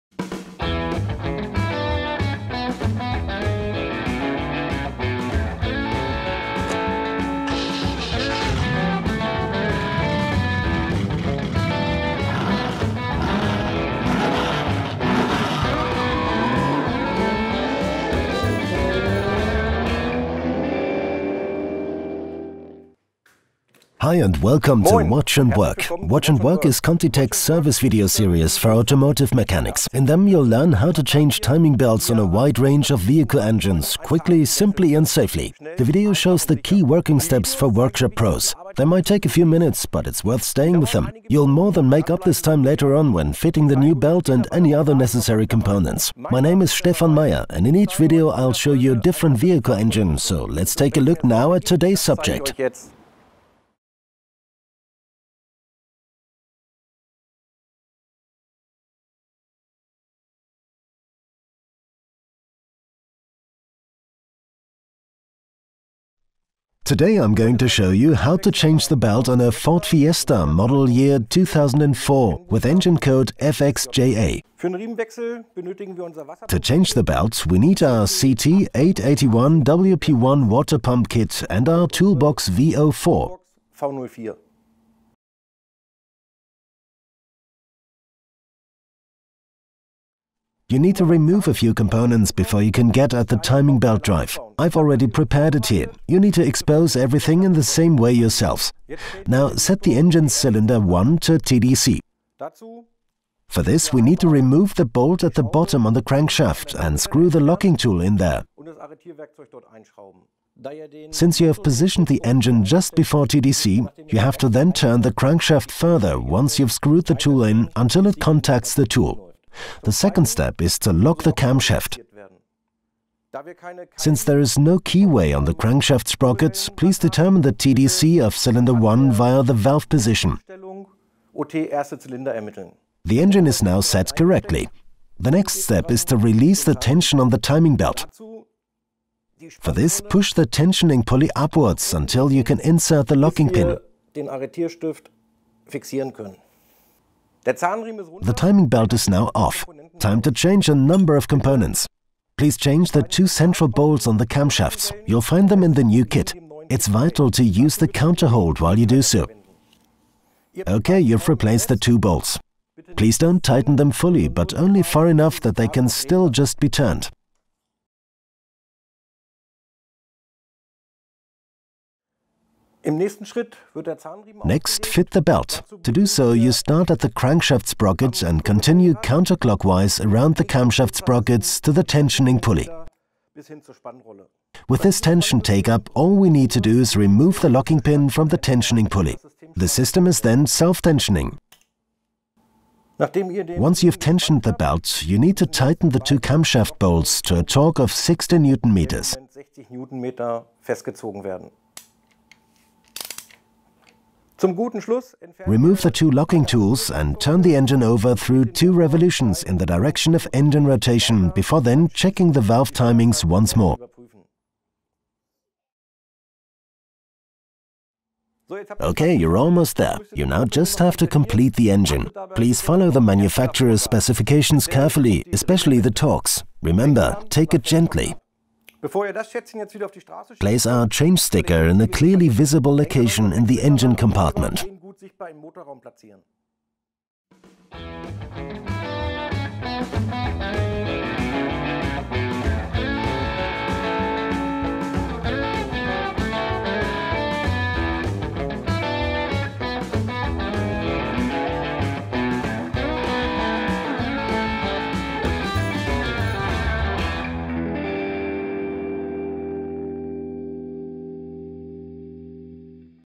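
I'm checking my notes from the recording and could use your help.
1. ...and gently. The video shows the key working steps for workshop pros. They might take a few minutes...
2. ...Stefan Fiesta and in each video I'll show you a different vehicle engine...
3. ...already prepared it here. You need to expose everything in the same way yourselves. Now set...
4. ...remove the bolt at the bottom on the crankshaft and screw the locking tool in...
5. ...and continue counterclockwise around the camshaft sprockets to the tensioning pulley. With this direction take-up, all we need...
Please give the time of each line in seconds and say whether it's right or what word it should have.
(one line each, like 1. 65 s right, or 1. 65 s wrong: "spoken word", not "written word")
1. 34 s wrong: "safely", not "gently"
2. 46 s wrong: "Meyer", not "Fiesta"
3. 94 s right
4. 104 s right
5. 178 s wrong: "tension", not "direction".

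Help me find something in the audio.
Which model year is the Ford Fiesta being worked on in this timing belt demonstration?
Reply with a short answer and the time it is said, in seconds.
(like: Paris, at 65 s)
2004, at 71 s.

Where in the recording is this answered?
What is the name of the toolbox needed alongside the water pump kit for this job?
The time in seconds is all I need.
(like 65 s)
82 s.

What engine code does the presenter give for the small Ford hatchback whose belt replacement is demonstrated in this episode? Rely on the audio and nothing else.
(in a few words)
FXJA.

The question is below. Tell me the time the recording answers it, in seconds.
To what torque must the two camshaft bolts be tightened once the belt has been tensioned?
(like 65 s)
197 s.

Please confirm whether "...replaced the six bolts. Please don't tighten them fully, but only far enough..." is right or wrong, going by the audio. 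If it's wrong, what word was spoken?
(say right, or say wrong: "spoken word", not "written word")
wrong: "two", not "six".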